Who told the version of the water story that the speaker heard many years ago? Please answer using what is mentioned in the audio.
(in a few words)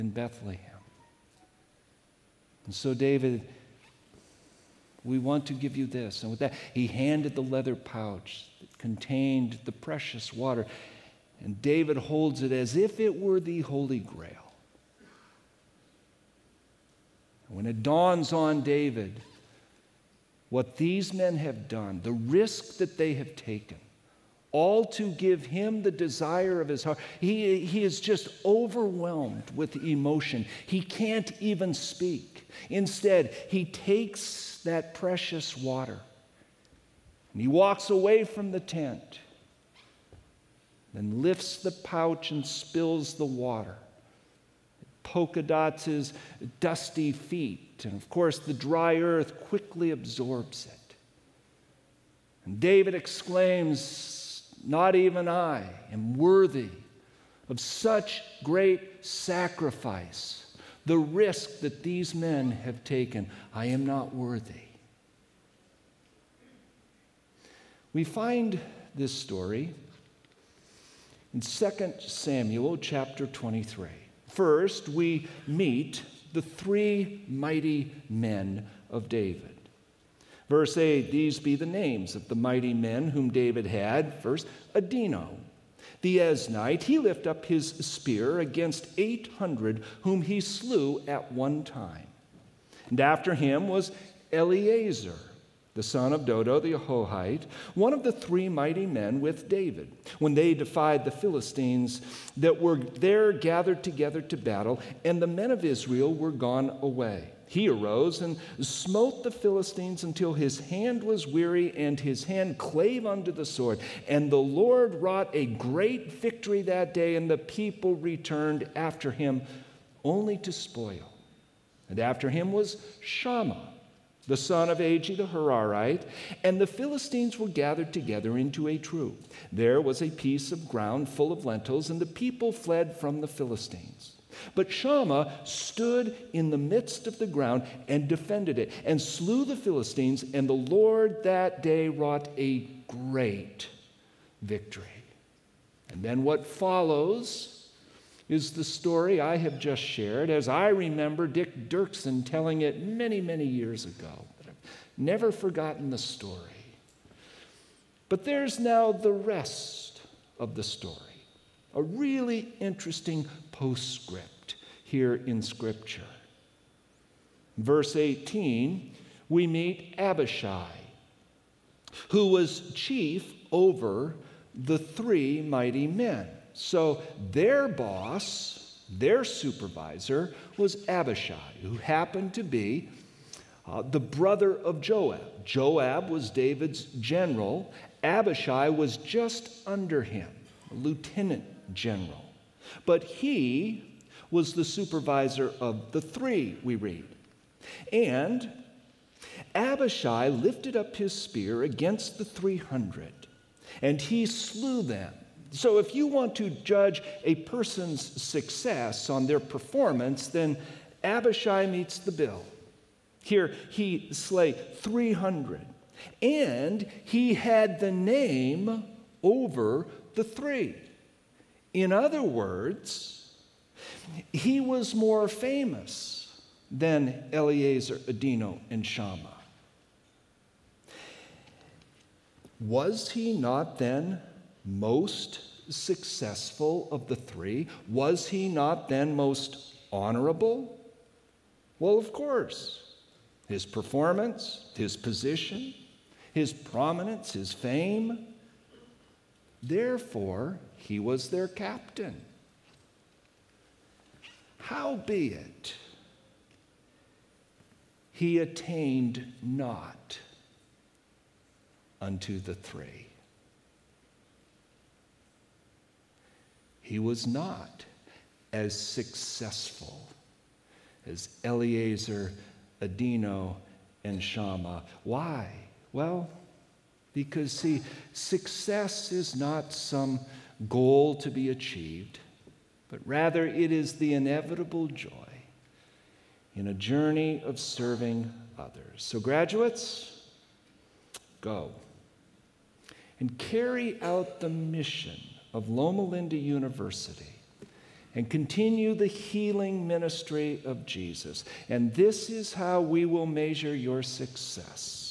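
Dick Duerksen.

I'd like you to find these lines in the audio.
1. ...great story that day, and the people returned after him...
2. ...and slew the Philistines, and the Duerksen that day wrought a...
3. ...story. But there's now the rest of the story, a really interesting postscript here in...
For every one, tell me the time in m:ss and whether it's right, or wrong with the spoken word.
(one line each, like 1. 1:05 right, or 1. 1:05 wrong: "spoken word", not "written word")
1. 1:55 wrong: "victory", not "story"
2. 2:18 wrong: "Lord", not "Duerksen"
3. 2:35 right.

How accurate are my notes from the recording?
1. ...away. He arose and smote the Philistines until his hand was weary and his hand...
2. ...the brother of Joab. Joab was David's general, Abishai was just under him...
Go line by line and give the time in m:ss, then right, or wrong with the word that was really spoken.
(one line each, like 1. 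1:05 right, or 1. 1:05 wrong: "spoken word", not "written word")
1. 1:46 right
2. 3:03 right.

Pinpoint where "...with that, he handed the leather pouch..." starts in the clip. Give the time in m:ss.
0:06.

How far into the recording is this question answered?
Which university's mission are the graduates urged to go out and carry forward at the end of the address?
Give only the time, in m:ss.
4:55.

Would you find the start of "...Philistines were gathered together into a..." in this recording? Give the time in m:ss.
2:06.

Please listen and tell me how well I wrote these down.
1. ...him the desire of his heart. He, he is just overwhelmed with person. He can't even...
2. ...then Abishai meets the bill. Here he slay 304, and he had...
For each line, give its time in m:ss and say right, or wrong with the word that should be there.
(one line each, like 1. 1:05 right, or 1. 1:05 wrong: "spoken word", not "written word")
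1. 0:25 wrong: "emotion", not "person"
2. 3:30 wrong: "300", not "304".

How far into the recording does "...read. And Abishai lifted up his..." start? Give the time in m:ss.
3:16.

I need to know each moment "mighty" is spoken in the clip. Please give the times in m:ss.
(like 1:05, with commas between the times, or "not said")
1:17, 1:22, 1:38, 2:55.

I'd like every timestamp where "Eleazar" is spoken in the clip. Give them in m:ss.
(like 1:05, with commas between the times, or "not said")
1:34, 3:47, 4:31.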